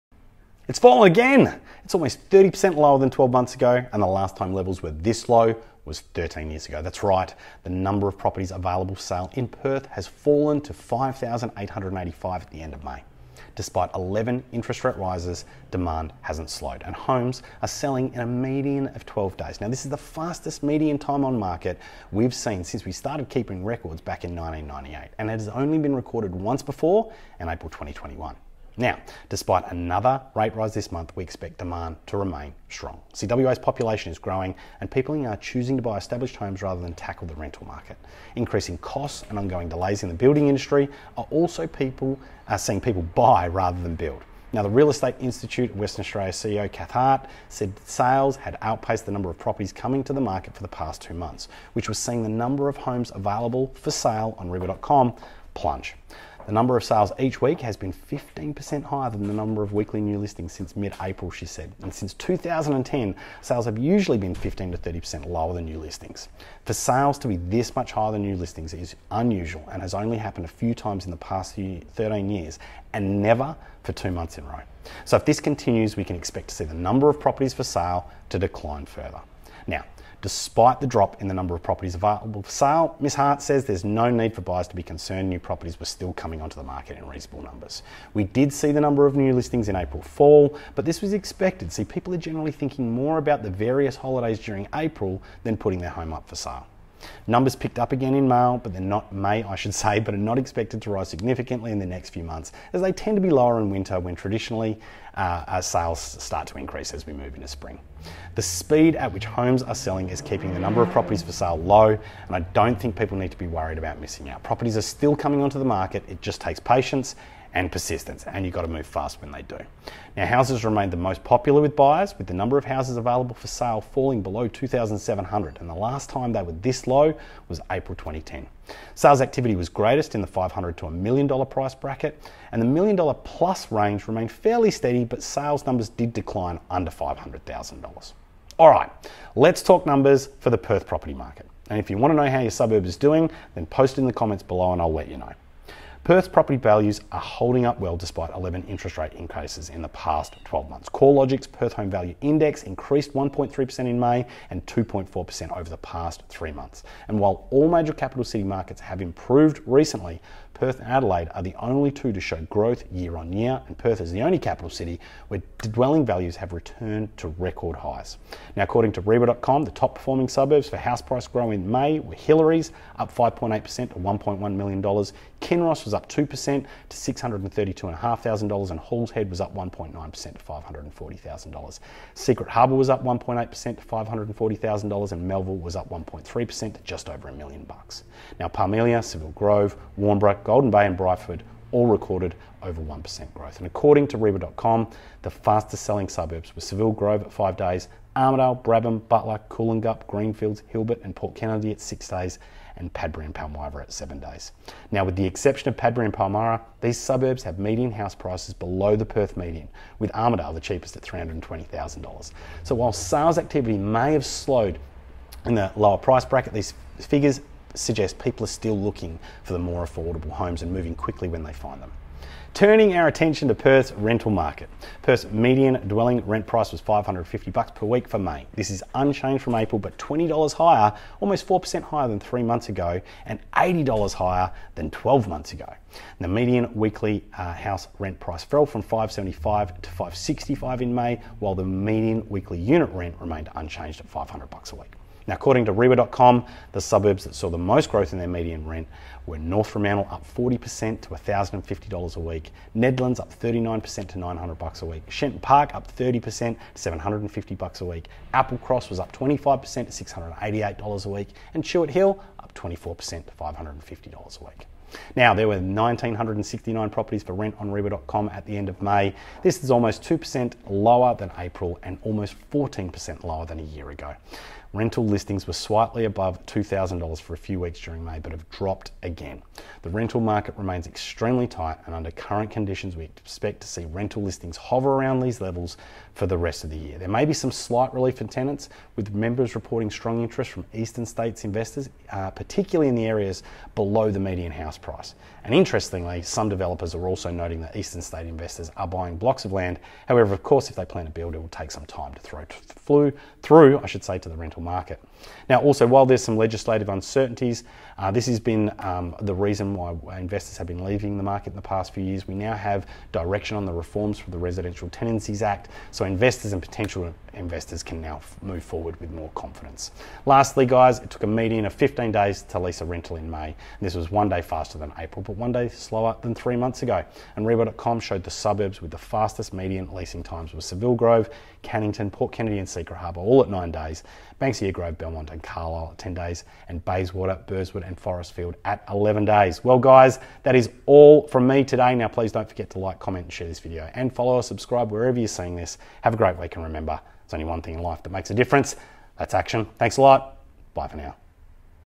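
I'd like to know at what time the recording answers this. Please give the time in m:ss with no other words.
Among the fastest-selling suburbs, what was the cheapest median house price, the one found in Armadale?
3:31.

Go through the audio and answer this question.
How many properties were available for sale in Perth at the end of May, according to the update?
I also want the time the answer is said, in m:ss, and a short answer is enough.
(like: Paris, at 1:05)
5,885, at 0:10.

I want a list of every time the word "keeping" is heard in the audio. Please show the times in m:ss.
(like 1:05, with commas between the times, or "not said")
0:23, 1:50.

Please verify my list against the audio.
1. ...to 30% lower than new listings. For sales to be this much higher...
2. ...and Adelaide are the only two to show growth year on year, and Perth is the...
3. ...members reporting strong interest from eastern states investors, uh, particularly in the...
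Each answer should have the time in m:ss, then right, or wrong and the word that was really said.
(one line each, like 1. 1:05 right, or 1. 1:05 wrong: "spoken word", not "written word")
1. 1:04 right
2. 2:40 right
3. 4:49 right.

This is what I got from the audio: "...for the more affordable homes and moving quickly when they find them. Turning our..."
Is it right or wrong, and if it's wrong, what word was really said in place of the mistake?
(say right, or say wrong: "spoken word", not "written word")
right.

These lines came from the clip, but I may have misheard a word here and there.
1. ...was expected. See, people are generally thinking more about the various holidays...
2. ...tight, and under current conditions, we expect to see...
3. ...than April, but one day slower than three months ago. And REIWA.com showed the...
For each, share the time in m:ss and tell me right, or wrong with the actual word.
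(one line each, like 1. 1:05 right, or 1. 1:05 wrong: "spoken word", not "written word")
1. 1:31 right
2. 4:41 right
3. 5:24 right.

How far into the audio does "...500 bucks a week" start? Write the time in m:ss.
4:04.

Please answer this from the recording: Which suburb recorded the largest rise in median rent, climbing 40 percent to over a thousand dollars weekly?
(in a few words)
North Fremantle.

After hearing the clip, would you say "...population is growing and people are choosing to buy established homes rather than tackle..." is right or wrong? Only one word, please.
right.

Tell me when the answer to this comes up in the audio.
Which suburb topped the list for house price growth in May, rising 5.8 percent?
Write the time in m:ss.
2:52.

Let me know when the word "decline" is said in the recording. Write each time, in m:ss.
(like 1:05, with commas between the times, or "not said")
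1:18, 2:16.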